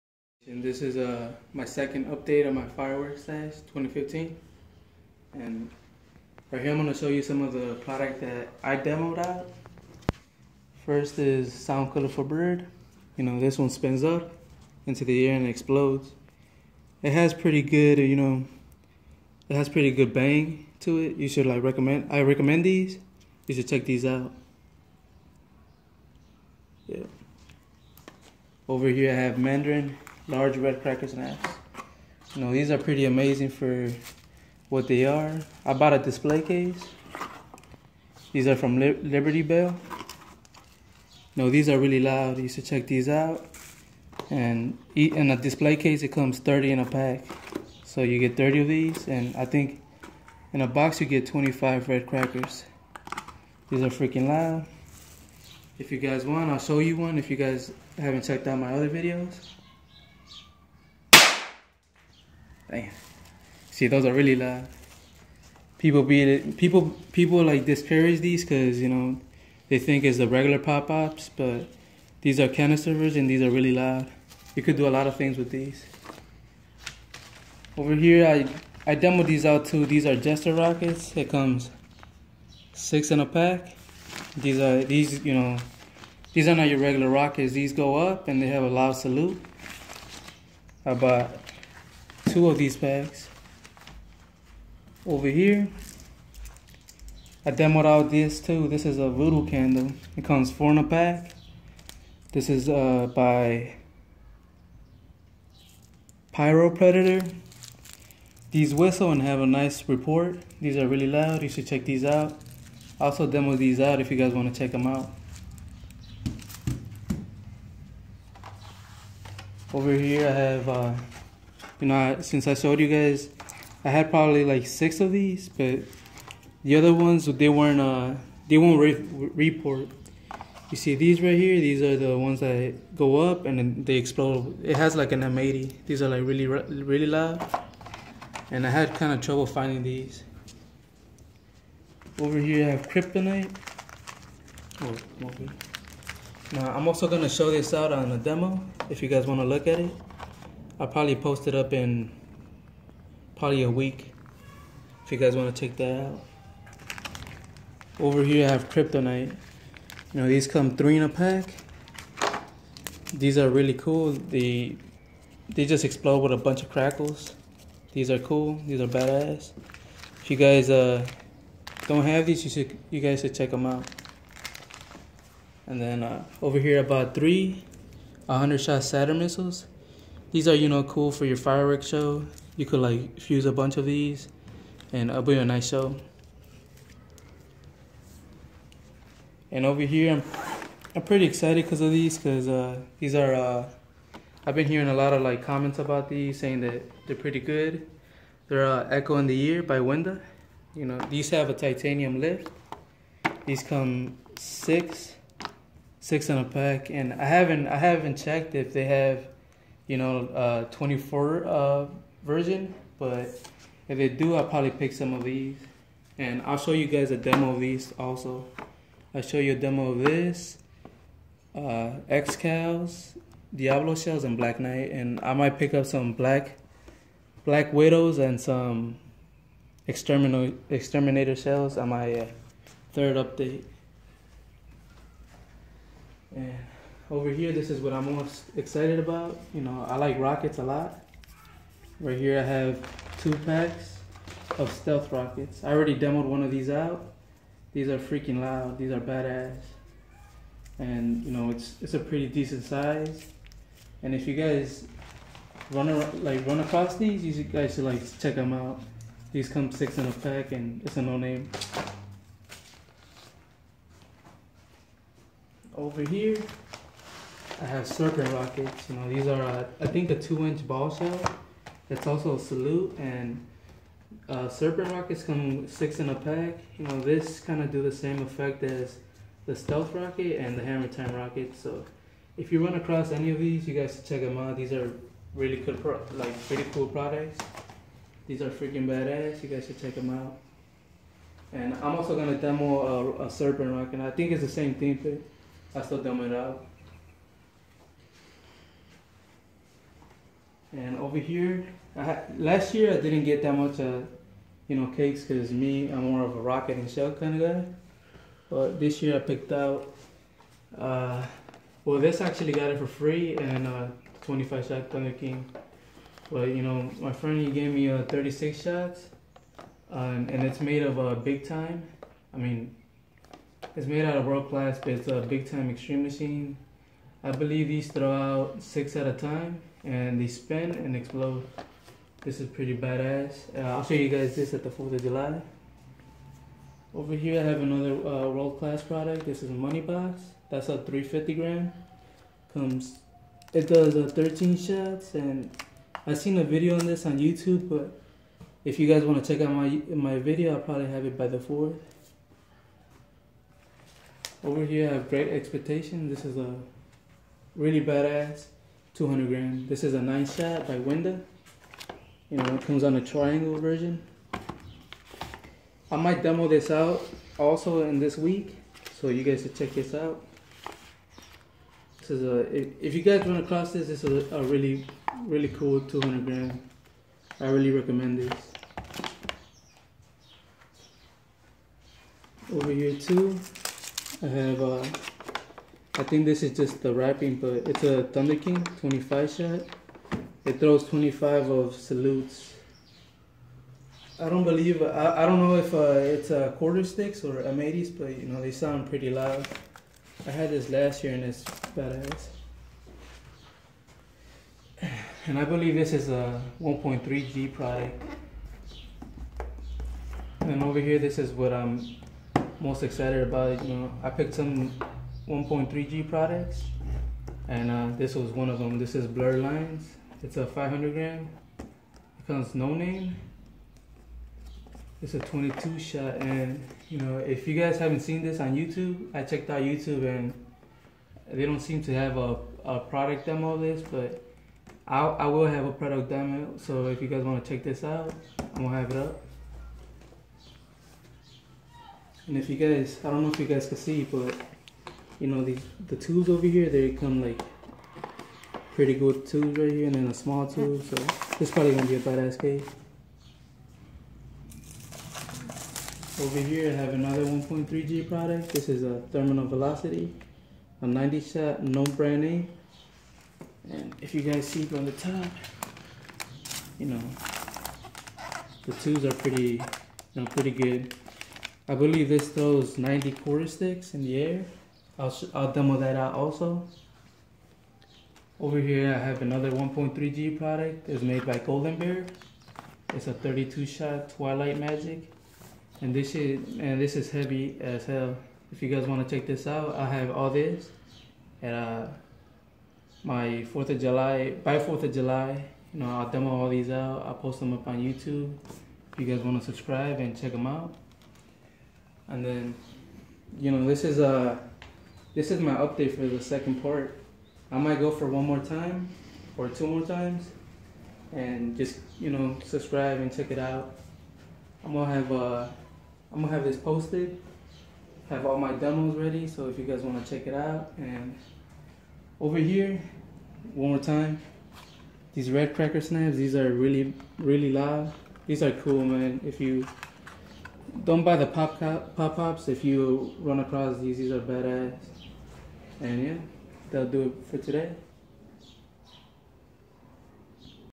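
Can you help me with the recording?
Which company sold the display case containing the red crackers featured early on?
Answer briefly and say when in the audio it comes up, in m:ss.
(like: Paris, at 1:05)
Liberty Bell, at 0:38.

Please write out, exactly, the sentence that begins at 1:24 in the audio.
These are these you know these are not your regular rockets.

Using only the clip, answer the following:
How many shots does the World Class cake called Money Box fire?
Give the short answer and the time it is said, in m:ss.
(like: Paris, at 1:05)
13, at 5:44.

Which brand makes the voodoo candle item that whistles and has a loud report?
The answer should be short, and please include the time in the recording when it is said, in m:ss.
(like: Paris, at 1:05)
Pyro Predator, at 1:46.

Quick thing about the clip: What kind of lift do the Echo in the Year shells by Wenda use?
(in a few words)
titanium.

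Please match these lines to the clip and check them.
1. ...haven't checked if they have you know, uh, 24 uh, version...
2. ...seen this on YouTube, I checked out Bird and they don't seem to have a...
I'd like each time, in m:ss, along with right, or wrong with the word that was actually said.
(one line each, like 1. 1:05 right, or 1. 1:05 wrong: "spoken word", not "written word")
1. 3:27 right
2. 7:08 wrong: "YouTube", not "Bird".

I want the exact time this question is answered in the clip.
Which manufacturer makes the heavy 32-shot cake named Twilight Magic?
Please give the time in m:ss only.
8:01.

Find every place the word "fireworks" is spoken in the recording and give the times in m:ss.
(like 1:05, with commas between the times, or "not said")
0:02, 3:01.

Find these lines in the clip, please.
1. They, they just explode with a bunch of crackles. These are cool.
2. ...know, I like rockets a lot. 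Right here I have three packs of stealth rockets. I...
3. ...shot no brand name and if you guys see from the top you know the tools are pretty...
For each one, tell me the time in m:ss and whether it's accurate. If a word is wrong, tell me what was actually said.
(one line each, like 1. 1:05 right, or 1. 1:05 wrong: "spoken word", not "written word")
1. 2:44 right
2. 3:59 wrong: "two", not "three"
3. 7:41 right.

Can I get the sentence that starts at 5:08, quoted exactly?
But this year I picked out, uh, well, this actually got it for free and uh, 25 shot Thunder King.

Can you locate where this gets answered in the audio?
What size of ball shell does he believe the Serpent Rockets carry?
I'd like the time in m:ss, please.
4:30.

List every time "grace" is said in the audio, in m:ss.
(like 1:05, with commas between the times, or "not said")
not said.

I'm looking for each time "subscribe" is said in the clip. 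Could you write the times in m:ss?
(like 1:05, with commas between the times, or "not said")
8:19, 8:32.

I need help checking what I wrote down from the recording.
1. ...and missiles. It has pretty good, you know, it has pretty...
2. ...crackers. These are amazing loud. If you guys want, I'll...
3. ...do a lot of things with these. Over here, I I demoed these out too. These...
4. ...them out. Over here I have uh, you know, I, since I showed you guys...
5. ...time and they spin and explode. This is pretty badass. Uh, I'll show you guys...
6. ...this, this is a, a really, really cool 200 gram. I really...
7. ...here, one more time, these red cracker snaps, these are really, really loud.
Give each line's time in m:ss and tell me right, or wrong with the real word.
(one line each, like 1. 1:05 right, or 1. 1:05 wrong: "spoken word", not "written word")
1. 0:15 wrong: "explodes", not "missiles"
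2. 0:52 wrong: "freaking", not "amazing"
3. 1:14 right
4. 1:54 right
5. 5:29 right
6. 6:13 right
7. 8:42 right.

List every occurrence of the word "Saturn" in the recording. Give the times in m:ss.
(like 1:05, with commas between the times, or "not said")
2:58.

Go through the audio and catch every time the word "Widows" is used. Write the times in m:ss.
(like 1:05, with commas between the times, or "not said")
3:47.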